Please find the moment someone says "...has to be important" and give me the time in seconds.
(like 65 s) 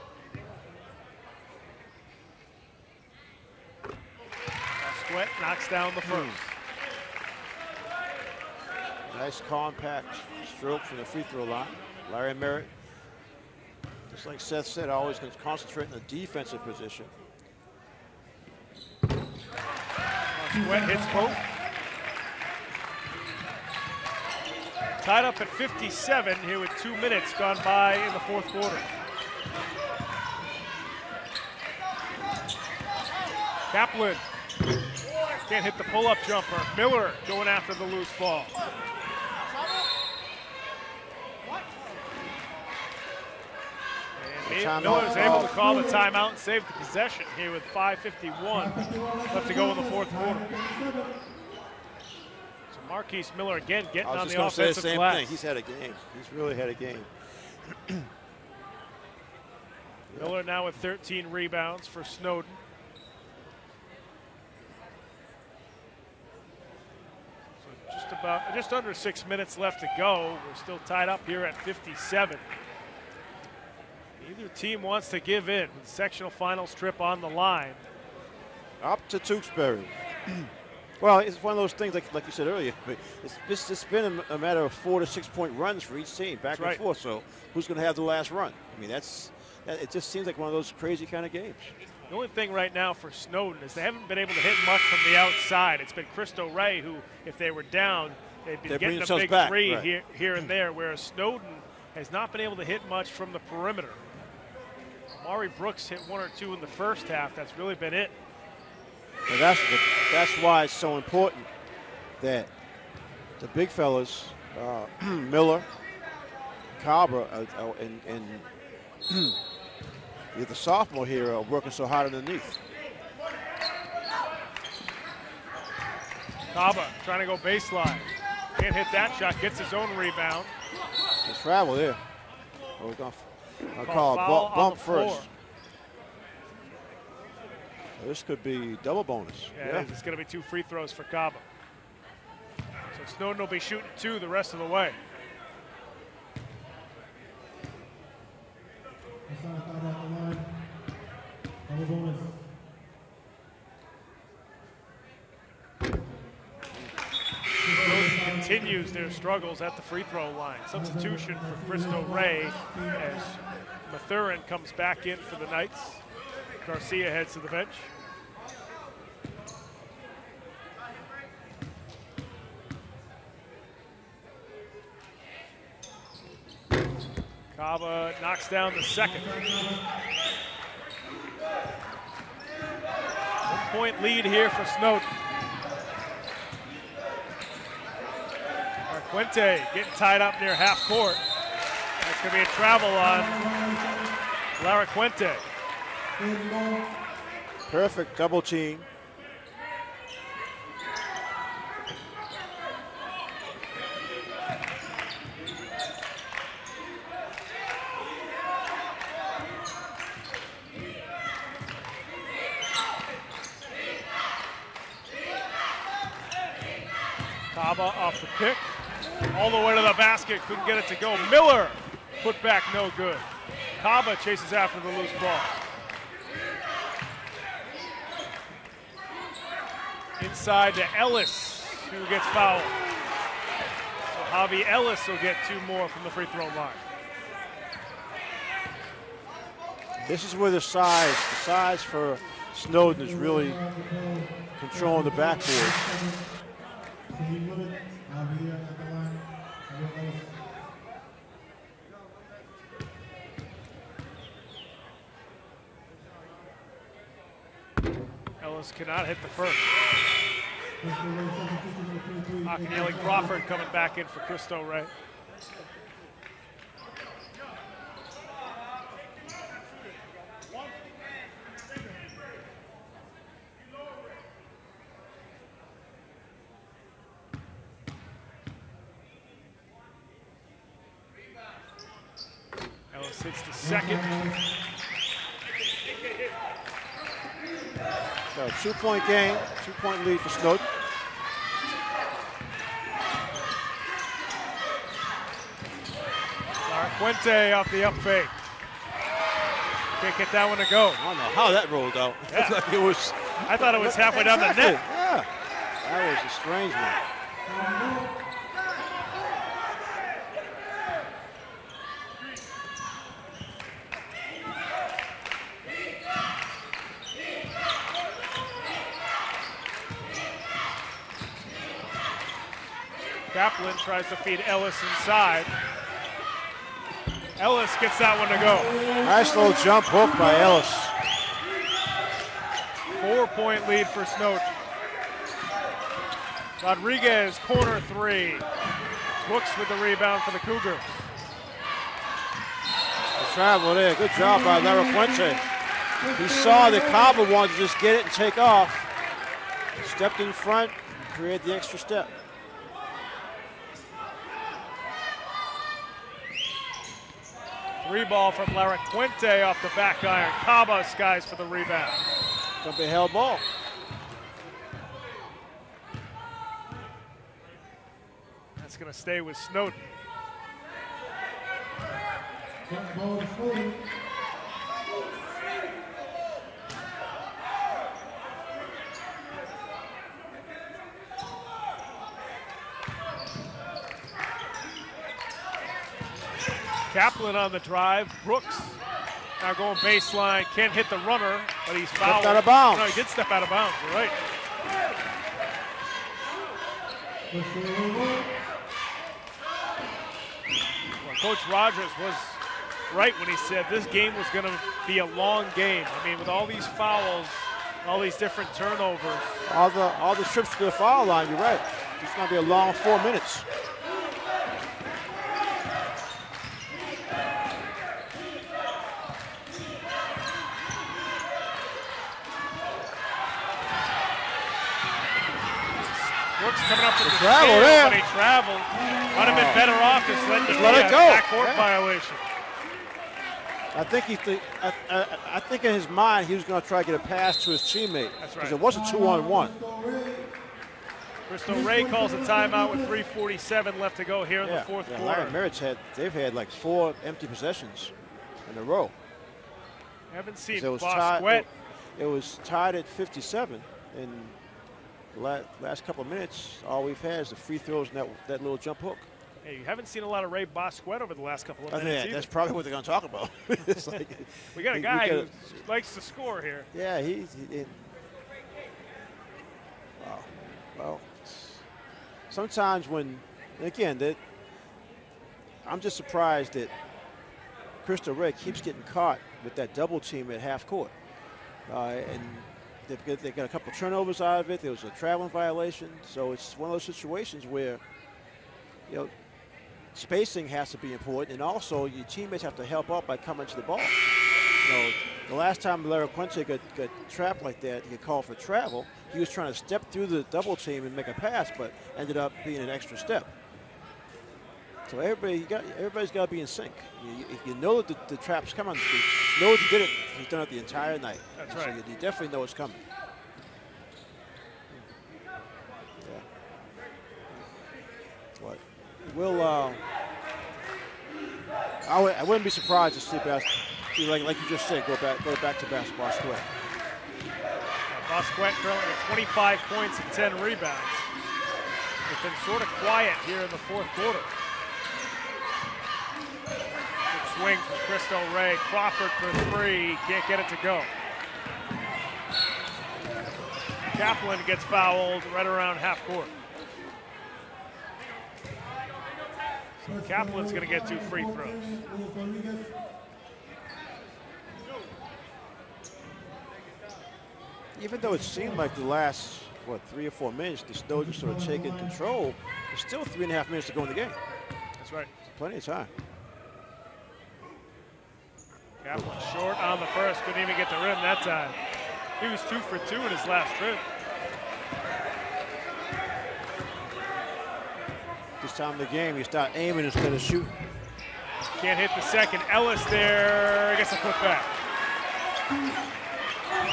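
490 s.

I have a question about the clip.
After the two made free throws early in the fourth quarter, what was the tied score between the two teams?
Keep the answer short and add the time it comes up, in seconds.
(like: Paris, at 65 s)
57, at 25 s.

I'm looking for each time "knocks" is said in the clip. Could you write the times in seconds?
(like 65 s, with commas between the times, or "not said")
5 s, 178 s.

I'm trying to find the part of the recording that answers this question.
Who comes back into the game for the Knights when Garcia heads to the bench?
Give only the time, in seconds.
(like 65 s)
163 s.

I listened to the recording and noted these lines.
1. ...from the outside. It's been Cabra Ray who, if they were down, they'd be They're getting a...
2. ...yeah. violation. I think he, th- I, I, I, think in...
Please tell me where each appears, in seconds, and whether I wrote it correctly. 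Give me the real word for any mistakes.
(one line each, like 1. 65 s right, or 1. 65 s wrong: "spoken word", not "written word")
1. 94 s wrong: "Cristo", not "Cabra"
2. 431 s right.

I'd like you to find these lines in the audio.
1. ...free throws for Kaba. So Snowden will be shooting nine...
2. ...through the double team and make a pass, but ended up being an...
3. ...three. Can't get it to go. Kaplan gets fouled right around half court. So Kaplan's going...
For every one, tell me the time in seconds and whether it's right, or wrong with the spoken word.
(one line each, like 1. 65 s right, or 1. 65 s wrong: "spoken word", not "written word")
1. 140 s wrong: "two", not "nine"
2. 499 s right
3. 539 s right.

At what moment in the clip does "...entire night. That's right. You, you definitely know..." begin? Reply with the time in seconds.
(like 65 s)
510 s.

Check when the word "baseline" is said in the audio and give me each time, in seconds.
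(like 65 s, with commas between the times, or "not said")
127 s, 389 s.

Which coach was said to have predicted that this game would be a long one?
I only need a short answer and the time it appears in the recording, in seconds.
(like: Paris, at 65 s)
Coach Rogers, at 401 s.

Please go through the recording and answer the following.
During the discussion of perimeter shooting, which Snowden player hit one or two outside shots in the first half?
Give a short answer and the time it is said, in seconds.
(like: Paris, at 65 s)
Mari Brooks, at 105 s.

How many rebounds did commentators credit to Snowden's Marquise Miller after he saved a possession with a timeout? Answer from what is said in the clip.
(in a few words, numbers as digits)
13.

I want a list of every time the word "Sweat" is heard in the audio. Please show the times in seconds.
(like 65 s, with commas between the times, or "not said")
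5 s, 19 s.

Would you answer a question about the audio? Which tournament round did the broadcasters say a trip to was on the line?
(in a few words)
Sectional finals.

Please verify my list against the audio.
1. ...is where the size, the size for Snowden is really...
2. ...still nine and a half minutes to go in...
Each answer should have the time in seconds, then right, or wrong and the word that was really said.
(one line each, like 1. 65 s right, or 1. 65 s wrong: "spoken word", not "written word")
1. 240 s right
2. 562 s wrong: "three", not "nine".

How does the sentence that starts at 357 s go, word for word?
Three ball from Larry Quinte off the back iron.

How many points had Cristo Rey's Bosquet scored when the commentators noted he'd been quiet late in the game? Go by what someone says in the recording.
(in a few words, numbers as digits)
25.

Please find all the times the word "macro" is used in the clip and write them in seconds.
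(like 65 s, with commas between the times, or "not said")
not said.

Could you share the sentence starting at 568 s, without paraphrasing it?
Kaplan short on the first, couldn't even get the rim that time.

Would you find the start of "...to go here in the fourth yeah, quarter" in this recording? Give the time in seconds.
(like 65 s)
443 s.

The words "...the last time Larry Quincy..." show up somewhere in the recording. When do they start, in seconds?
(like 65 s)
495 s.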